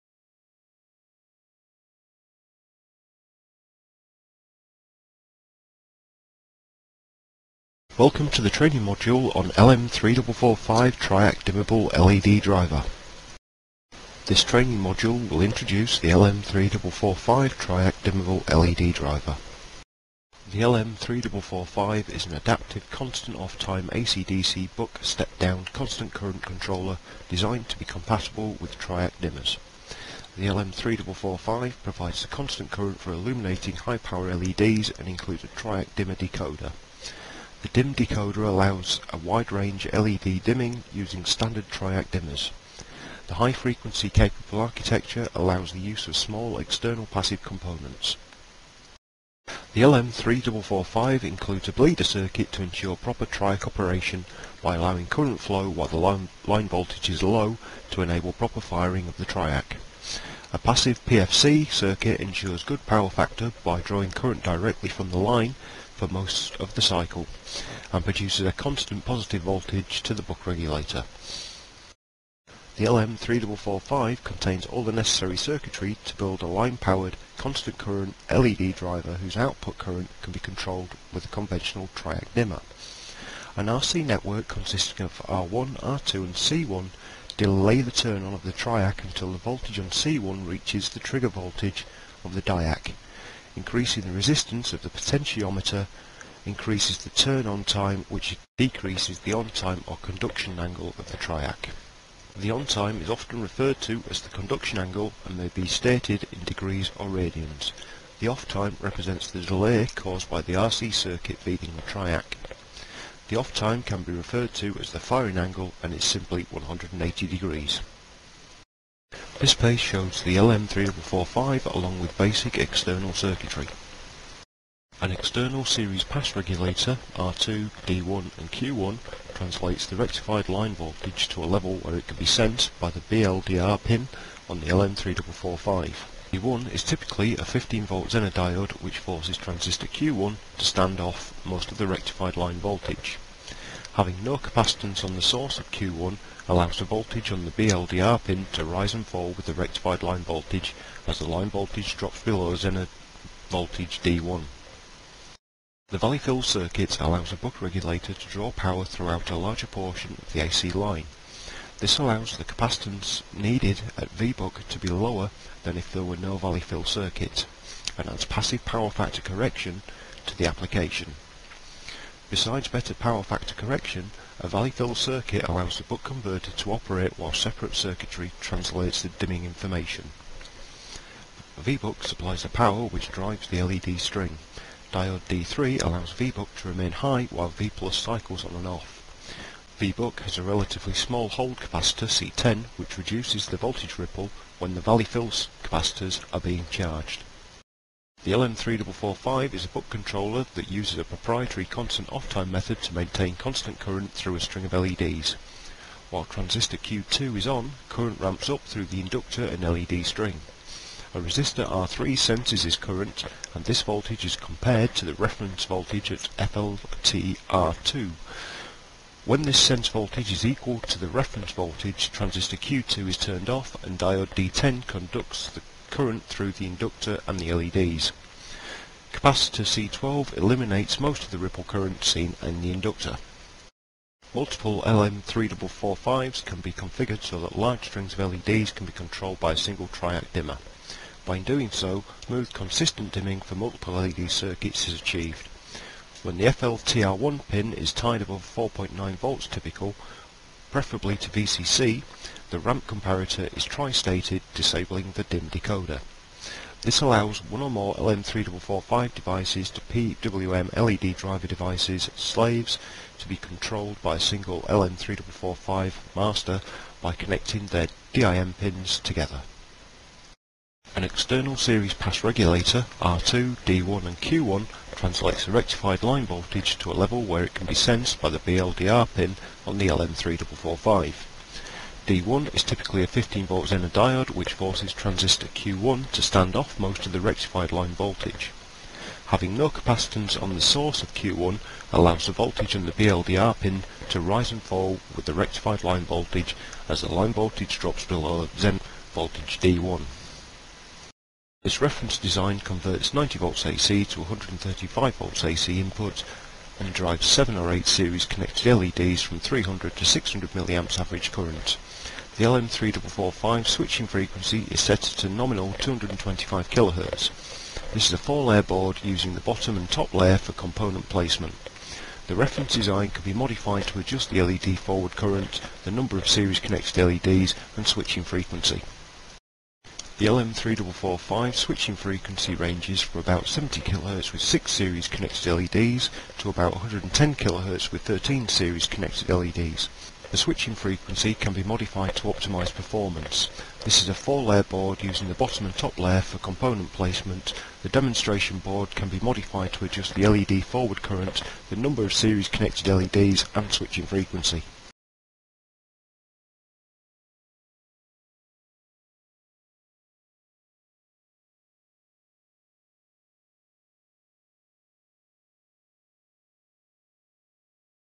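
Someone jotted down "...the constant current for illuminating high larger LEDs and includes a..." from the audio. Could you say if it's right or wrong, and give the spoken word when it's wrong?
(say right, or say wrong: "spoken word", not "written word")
wrong: "power", not "larger".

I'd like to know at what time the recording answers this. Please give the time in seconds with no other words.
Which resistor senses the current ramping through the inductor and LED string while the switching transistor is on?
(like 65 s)
211 s.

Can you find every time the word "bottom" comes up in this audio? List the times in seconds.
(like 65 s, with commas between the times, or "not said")
319 s, 345 s.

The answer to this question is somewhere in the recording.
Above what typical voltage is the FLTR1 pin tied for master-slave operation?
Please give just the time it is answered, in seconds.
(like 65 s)
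248 s.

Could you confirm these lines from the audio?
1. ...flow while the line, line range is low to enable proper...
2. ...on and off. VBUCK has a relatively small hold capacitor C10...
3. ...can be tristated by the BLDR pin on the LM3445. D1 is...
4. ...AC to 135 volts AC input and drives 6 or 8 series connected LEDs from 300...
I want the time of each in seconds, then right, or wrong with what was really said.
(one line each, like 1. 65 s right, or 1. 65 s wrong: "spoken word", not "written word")
1. 55 s wrong: "voltage", not "range"
2. 188 s right
3. 277 s wrong: "sensed", not "tristated"
4. 303 s wrong: "7", not "6".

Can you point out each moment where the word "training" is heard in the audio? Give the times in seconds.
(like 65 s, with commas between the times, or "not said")
8 s, 14 s.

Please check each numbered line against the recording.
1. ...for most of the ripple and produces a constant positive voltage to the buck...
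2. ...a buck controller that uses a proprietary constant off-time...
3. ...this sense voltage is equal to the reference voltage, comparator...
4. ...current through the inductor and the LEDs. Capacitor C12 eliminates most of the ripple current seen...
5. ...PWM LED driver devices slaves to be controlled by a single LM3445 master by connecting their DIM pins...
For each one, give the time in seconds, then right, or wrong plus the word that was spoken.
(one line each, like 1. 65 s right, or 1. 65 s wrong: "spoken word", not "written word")
1. 66 s wrong: "cycle", not "ripple"
2. 199 s right
3. 219 s wrong: "transistor", not "comparator"
4. 225 s right
5. 259 s right.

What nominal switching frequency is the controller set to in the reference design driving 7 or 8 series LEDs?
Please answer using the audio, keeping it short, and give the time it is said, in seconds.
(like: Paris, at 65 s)
225 kHz, at 315 s.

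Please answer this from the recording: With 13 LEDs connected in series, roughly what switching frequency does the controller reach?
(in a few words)
110 kHz.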